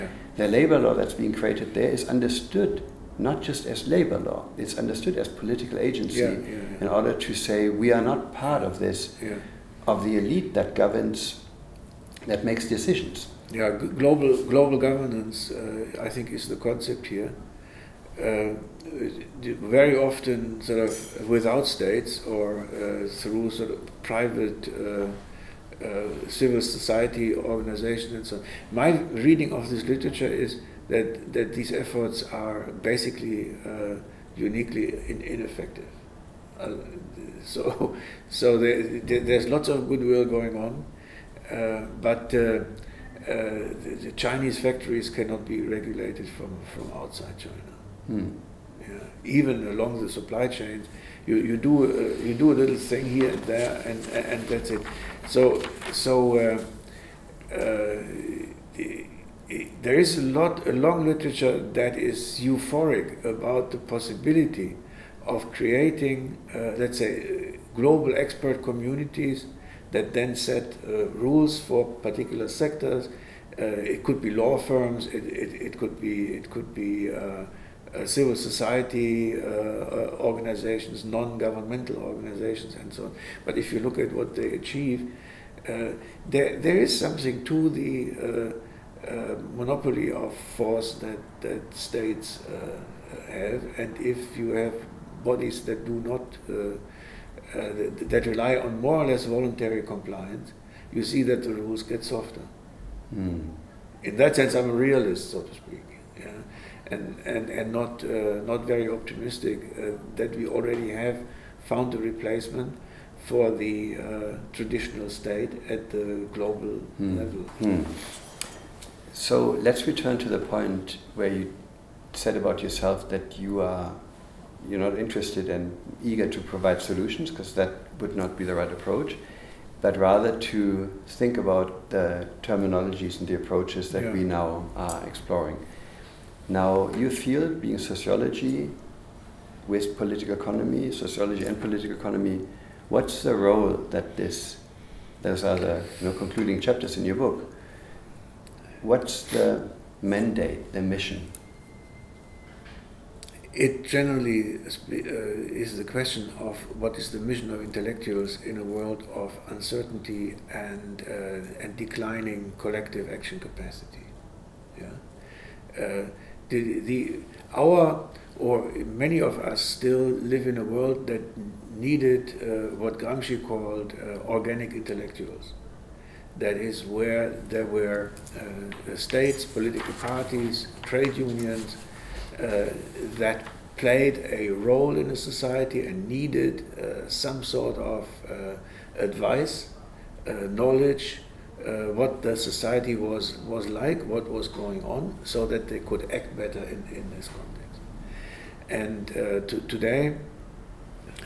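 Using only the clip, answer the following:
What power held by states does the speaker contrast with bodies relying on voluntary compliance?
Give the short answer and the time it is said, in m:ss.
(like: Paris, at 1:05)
monopoly of force, at 1:29.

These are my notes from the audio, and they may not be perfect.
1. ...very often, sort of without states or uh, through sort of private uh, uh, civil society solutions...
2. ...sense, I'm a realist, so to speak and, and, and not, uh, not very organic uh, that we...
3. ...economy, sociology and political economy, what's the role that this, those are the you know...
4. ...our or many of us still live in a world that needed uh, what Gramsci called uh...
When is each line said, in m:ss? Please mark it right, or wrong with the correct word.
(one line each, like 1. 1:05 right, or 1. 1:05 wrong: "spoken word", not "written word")
1. 0:19 wrong: "organizations", not "solutions"
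2. 1:44 wrong: "optimistic", not "organic"
3. 2:20 right
4. 2:47 right.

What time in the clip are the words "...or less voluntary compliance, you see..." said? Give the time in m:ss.
1:39.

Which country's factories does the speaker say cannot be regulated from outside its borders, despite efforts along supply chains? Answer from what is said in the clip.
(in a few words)
China.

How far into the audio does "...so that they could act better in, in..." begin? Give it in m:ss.
3:15.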